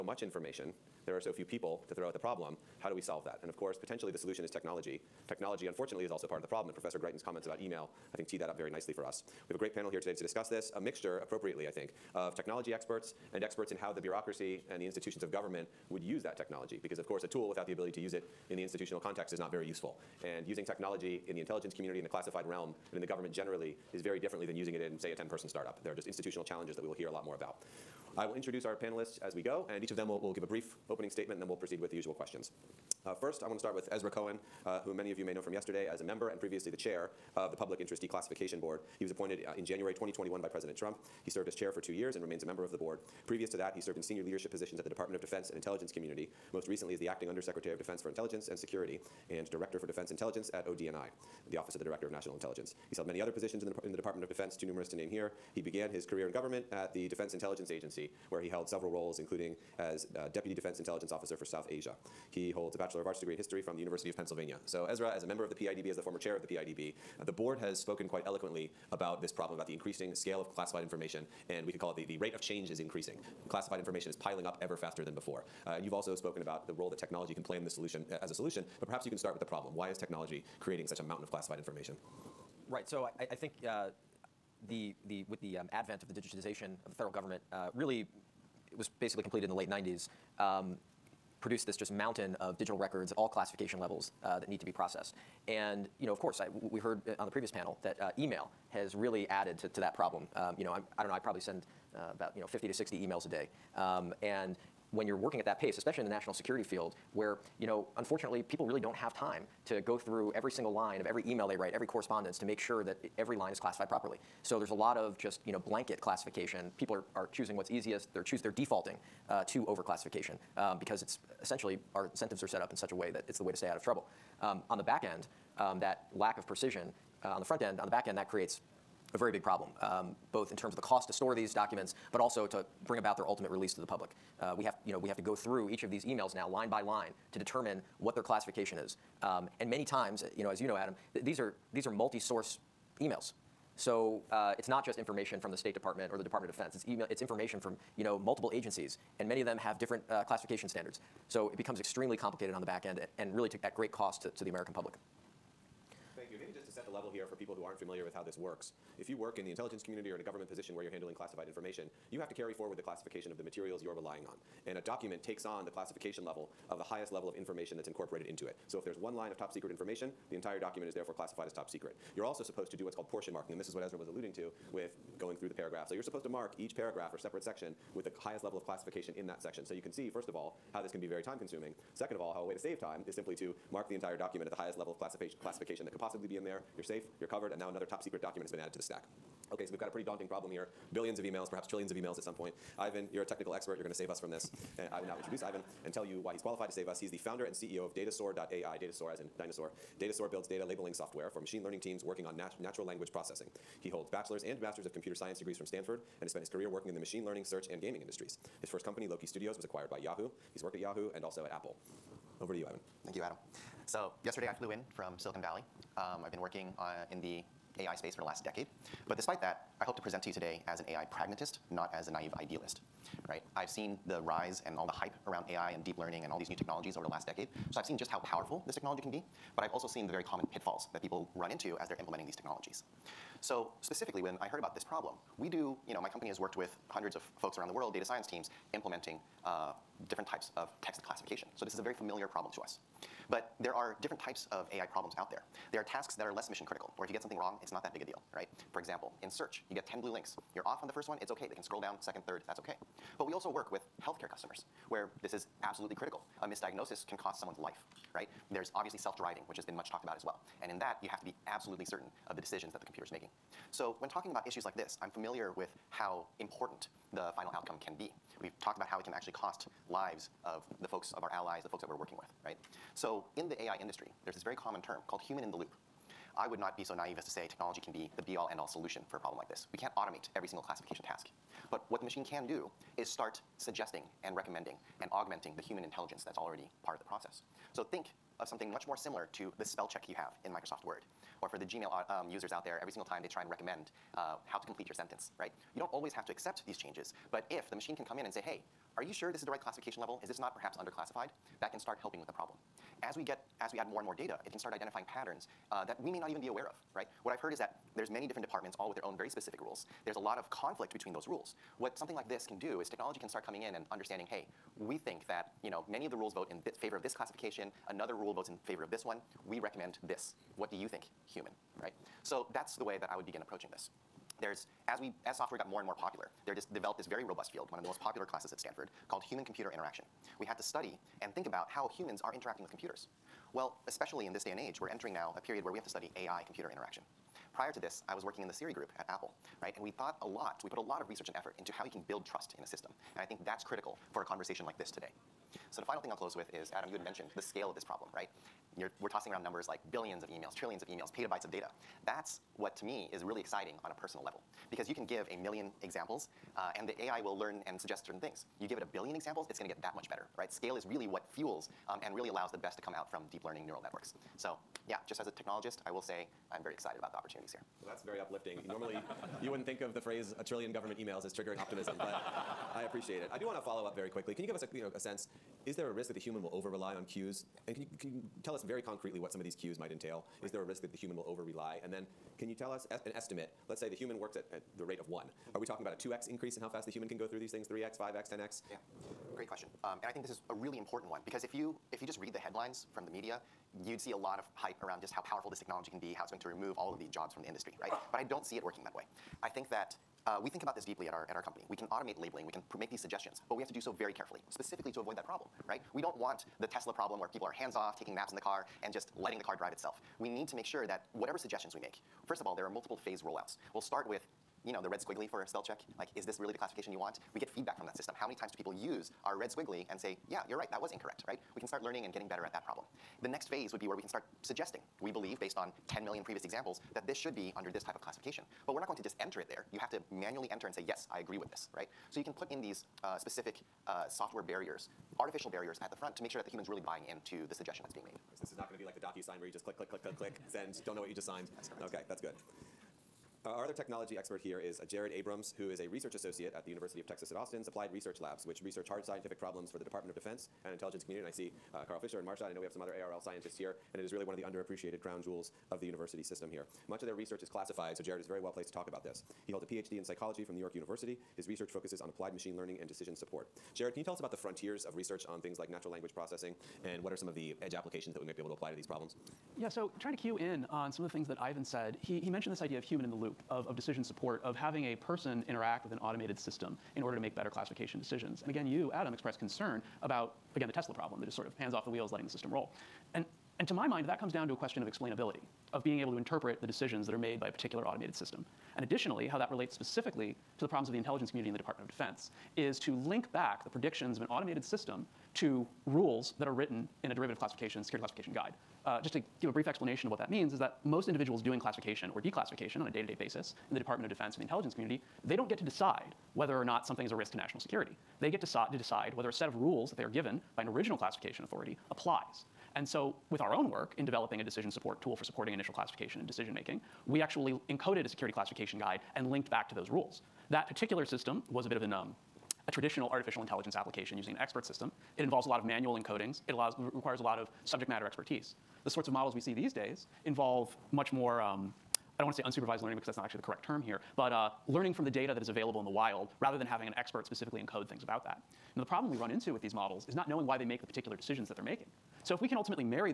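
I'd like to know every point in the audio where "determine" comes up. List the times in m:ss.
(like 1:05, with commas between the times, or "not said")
2:17.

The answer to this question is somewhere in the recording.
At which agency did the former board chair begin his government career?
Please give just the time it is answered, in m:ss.
0:57.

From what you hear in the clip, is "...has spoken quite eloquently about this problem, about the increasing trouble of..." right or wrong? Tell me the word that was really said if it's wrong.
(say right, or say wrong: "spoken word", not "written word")
wrong: "scale", not "trouble".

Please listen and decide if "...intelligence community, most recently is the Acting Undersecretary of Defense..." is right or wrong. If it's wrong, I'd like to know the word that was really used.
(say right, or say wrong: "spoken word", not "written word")
right.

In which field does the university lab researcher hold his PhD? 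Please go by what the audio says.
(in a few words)
Psychology.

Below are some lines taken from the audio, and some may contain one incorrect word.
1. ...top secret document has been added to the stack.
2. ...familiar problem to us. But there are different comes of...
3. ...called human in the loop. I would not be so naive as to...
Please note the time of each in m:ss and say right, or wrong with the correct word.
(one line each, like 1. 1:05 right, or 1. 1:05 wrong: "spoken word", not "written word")
1. 3:07 right
2. 4:01 wrong: "types", not "comes"
3. 4:35 right.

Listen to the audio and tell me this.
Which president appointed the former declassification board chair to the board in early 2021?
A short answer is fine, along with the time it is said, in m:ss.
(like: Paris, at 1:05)
President Trump, at 0:40.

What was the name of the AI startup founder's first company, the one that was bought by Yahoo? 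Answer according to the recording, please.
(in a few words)
Loki Studios.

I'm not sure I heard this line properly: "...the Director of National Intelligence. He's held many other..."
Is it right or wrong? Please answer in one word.
right.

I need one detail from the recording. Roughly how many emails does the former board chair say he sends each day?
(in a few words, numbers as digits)
50 to 60.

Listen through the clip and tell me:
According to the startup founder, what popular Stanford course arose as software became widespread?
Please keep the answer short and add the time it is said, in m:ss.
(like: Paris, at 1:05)
Human-computer interaction, at 5:29.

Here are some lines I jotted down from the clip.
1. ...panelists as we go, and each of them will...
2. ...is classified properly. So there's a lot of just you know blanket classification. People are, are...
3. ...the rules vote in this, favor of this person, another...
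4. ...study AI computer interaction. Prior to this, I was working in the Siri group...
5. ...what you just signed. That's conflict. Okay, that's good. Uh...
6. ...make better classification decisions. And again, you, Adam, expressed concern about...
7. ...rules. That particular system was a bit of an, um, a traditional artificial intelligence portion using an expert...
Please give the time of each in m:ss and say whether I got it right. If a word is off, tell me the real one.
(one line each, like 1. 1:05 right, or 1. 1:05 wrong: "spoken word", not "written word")
1. 0:28 right
2. 1:53 right
3. 5:16 wrong: "classification", not "person"
4. 5:35 right
5. 7:21 wrong: "correct", not "conflict"
6. 7:57 right
7. 8:39 wrong: "application", not "portion".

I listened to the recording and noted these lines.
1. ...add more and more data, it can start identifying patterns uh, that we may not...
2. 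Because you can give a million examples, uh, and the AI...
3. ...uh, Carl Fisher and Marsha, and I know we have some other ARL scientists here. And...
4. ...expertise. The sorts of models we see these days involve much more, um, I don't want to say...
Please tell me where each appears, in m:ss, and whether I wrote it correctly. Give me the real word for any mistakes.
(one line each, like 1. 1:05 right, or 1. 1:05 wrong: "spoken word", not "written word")
1. 5:03 right
2. 5:54 right
3. 7:31 right
4. 8:48 right.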